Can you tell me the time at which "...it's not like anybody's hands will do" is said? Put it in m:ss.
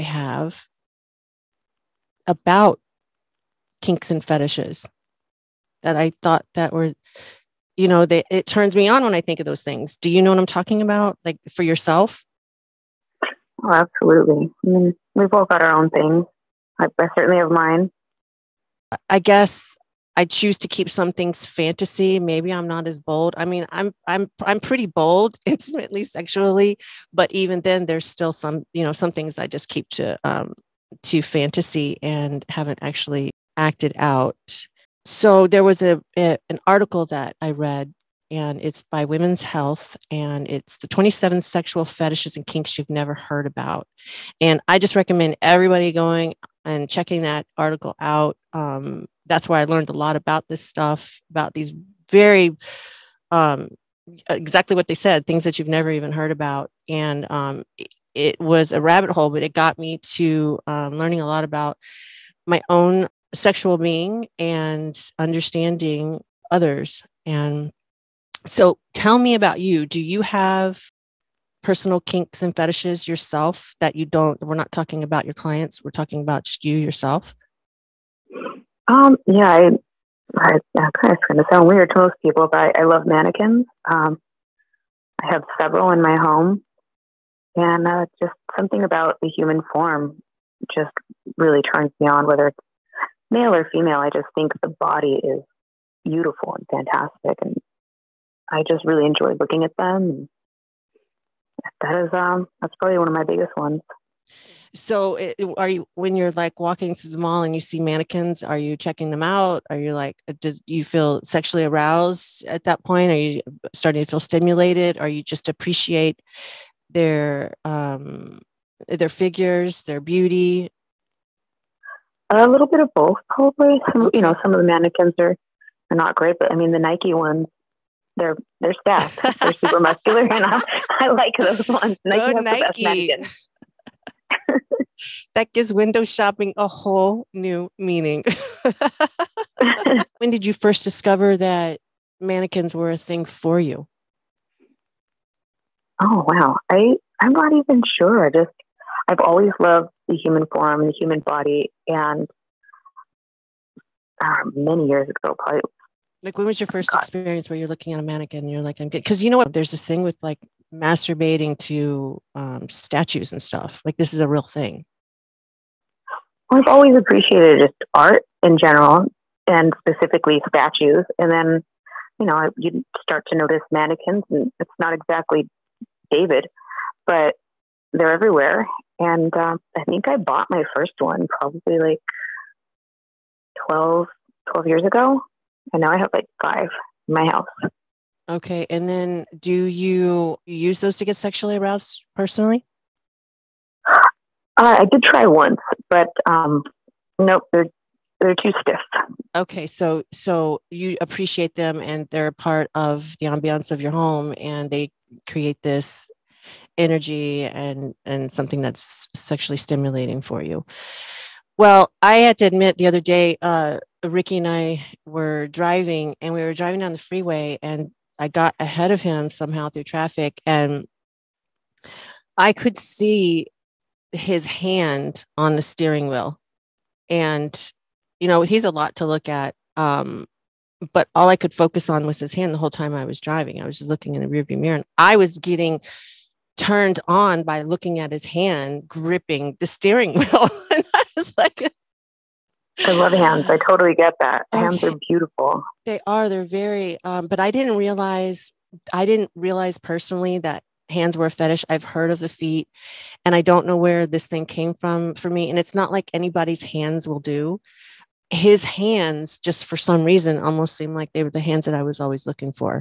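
4:15.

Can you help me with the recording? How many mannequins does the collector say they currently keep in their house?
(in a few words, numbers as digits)
5.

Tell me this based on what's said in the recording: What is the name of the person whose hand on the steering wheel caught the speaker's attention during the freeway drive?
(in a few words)
Ricky.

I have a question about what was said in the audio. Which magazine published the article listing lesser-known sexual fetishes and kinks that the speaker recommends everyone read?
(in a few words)
Women's Health.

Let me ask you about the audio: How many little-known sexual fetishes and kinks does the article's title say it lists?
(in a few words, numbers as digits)
27.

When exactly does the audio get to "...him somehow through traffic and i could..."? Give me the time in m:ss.
3:39.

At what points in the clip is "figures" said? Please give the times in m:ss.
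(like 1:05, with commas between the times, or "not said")
1:59.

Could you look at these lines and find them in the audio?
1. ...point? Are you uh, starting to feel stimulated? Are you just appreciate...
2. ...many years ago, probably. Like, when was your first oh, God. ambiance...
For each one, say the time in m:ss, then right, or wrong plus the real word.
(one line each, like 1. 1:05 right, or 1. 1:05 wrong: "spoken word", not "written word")
1. 1:52 right
2. 2:34 wrong: "experience", not "ambiance".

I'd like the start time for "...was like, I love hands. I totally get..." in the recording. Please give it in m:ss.
4:01.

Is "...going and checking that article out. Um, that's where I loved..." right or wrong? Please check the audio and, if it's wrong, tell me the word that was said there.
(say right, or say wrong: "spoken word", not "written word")
wrong: "learned", not "loved".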